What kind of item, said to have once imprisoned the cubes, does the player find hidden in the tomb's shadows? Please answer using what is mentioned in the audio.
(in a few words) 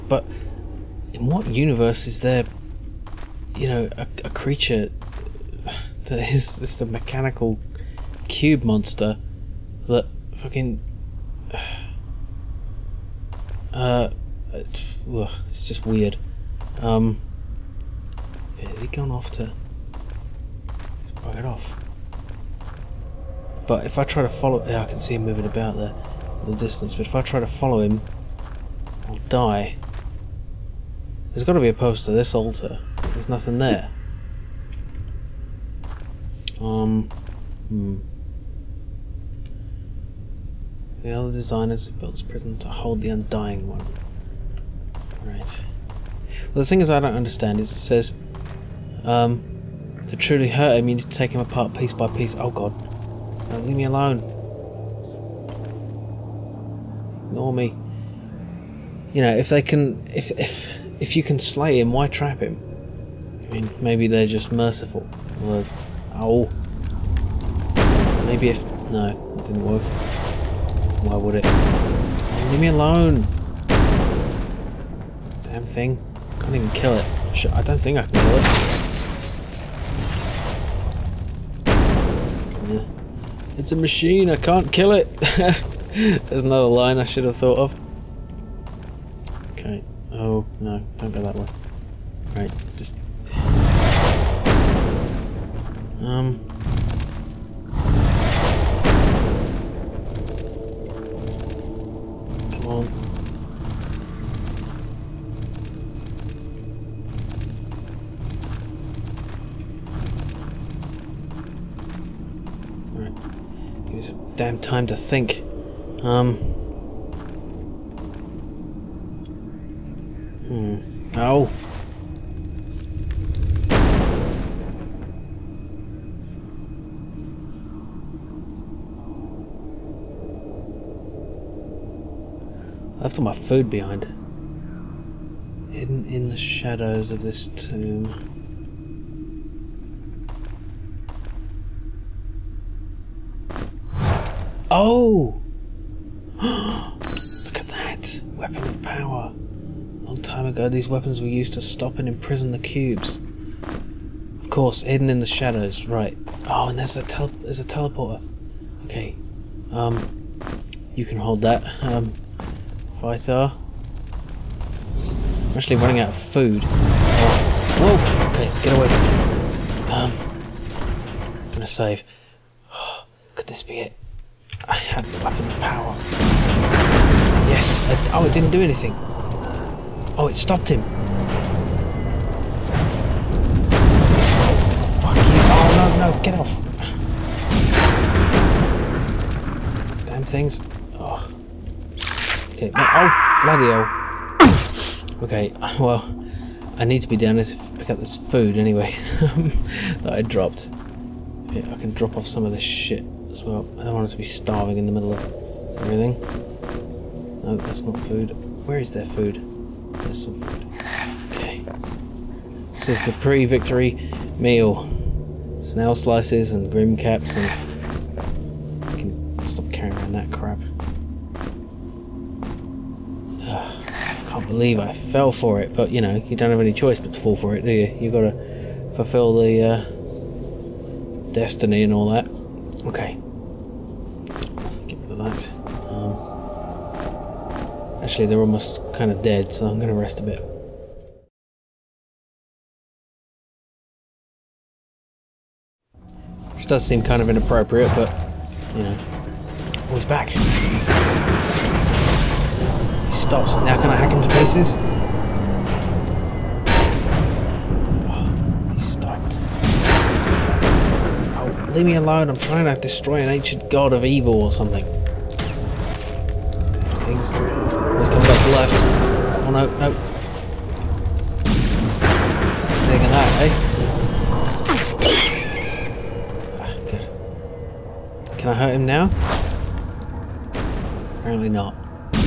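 Weapon of power.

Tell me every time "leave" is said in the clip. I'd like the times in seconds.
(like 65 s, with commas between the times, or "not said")
53 s, 72 s, 261 s.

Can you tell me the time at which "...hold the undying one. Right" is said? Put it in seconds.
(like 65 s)
42 s.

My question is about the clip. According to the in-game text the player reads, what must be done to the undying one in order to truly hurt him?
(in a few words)
Take him apart piece by piece.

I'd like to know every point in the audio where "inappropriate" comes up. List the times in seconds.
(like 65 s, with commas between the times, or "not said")
247 s.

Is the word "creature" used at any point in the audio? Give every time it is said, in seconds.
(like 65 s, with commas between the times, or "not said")
4 s.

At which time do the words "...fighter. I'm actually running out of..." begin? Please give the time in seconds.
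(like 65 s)
163 s.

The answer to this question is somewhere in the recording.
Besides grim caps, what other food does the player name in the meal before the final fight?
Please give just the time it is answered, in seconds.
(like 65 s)
215 s.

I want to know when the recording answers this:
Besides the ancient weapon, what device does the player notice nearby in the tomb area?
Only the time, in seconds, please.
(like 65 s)
157 s.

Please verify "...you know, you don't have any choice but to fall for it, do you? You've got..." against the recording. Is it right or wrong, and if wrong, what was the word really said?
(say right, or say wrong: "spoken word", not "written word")
right.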